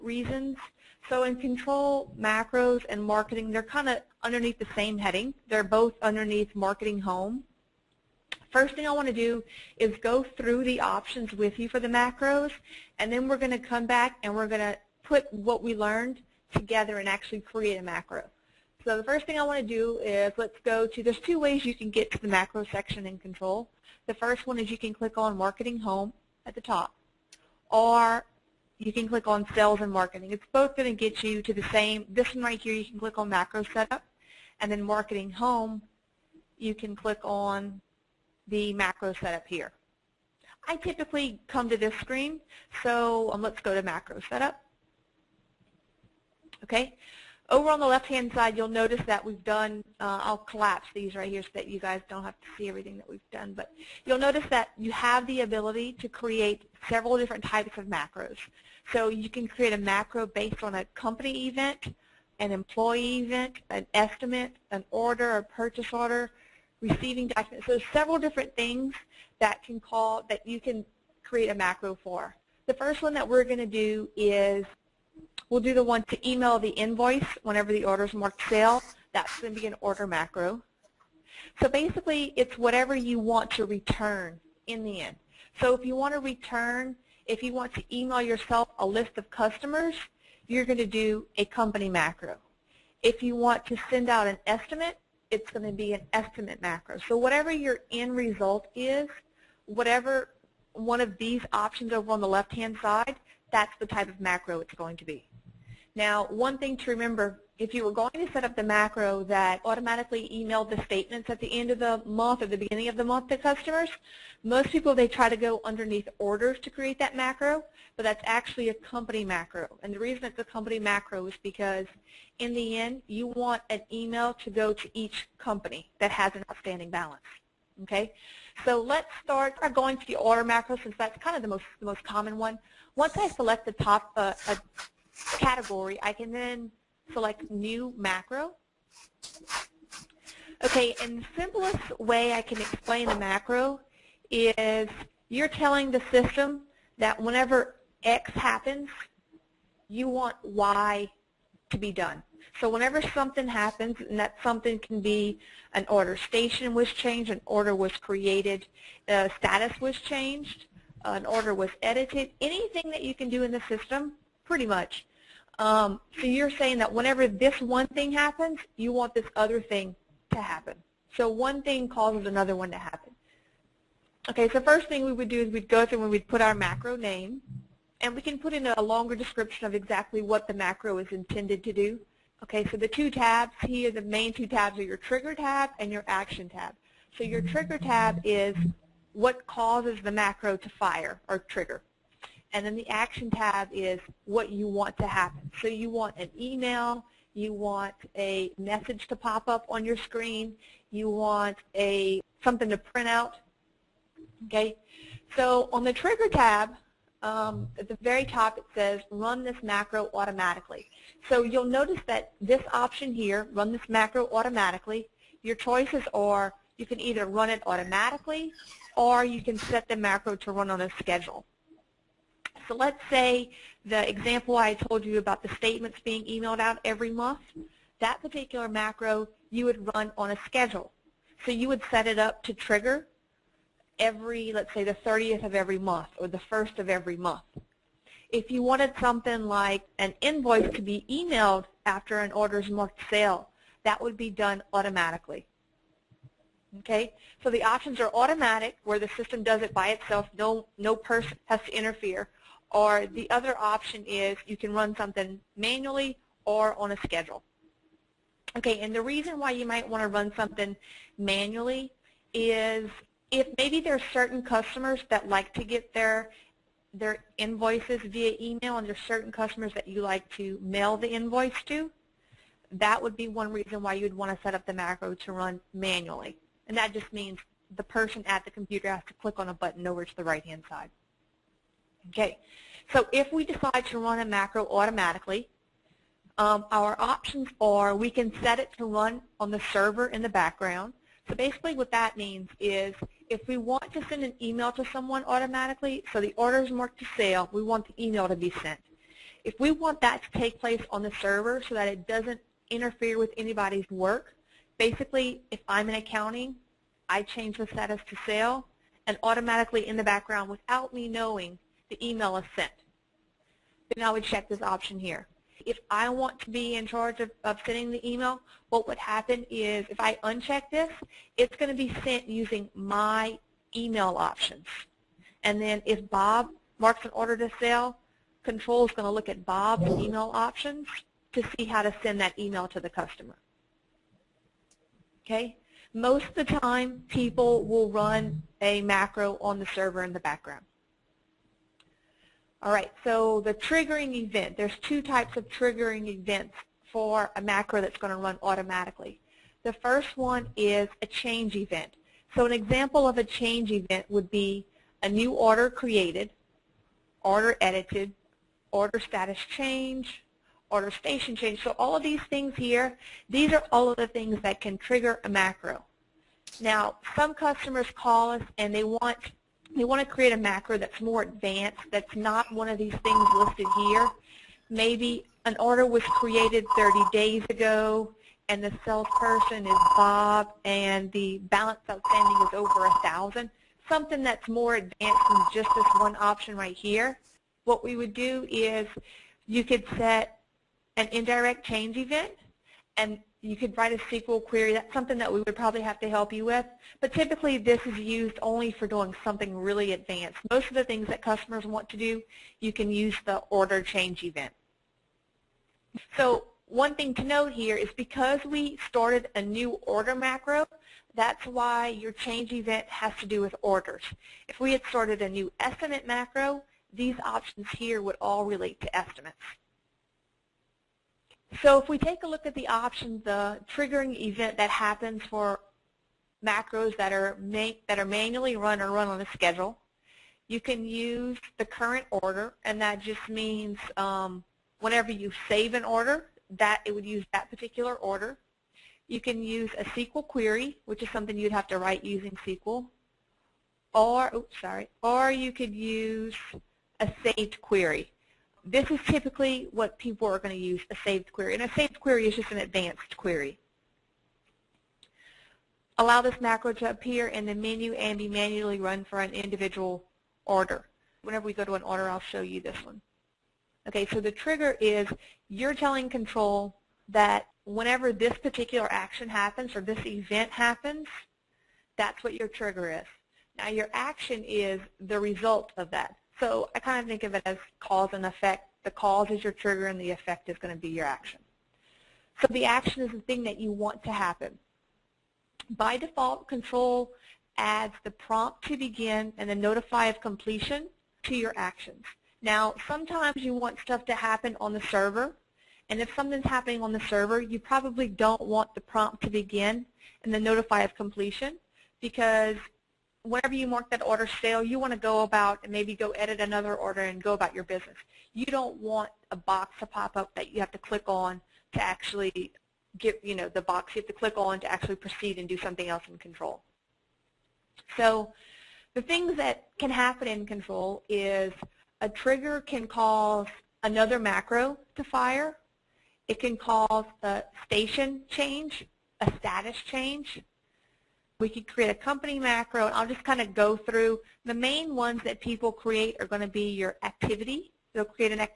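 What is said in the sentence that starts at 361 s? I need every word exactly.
So all of these things here, these are all of the things that can trigger a macro.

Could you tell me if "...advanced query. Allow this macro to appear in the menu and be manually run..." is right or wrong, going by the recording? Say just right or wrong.
right.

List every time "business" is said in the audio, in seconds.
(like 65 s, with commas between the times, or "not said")
507 s.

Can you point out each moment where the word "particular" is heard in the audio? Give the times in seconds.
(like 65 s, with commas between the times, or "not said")
228 s, 437 s, 468 s.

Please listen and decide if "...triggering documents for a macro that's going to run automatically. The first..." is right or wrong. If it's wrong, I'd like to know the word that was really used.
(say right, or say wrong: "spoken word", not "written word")
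wrong: "events", not "documents".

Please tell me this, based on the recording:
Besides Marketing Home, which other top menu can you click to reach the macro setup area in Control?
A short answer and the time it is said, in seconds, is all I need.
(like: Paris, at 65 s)
Sales and Marketing, at 29 s.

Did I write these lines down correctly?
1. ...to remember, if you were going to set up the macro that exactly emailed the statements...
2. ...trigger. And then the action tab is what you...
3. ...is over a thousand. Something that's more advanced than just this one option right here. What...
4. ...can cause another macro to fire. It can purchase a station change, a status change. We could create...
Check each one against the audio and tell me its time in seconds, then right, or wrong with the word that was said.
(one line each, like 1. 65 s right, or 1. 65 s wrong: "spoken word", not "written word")
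1. 106 s wrong: "automatically", not "exactly"
2. 191 s right
3. 382 s right
4. 522 s wrong: "cause", not "purchase".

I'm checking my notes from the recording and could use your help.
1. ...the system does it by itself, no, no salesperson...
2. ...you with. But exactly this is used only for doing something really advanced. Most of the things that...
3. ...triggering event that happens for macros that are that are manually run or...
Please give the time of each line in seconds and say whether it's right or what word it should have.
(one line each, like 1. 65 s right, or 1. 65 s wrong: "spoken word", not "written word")
1. 248 s wrong: "person", not "salesperson"
2. 396 s wrong: "typically", not "exactly"
3. 423 s right.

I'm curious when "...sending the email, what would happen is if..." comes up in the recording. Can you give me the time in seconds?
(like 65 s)
317 s.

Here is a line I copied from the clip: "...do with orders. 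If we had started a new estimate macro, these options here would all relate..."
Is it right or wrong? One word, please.
right.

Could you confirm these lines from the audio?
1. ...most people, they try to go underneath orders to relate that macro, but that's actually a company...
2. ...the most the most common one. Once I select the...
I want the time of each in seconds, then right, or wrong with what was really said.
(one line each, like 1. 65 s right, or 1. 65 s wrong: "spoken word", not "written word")
1. 114 s wrong: "create", not "relate"
2. 131 s right.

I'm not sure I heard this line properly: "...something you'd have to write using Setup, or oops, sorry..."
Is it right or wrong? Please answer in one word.
wrong.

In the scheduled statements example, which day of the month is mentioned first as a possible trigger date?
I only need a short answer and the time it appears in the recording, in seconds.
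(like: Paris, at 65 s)
30th, at 235 s.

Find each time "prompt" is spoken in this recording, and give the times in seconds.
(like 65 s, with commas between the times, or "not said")
488 s, 498 s.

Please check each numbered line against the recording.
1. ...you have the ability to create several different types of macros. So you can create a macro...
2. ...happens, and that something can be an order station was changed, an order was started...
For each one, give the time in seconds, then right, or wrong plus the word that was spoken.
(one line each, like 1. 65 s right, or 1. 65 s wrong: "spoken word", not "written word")
1. 54 s right
2. 153 s wrong: "created", not "started".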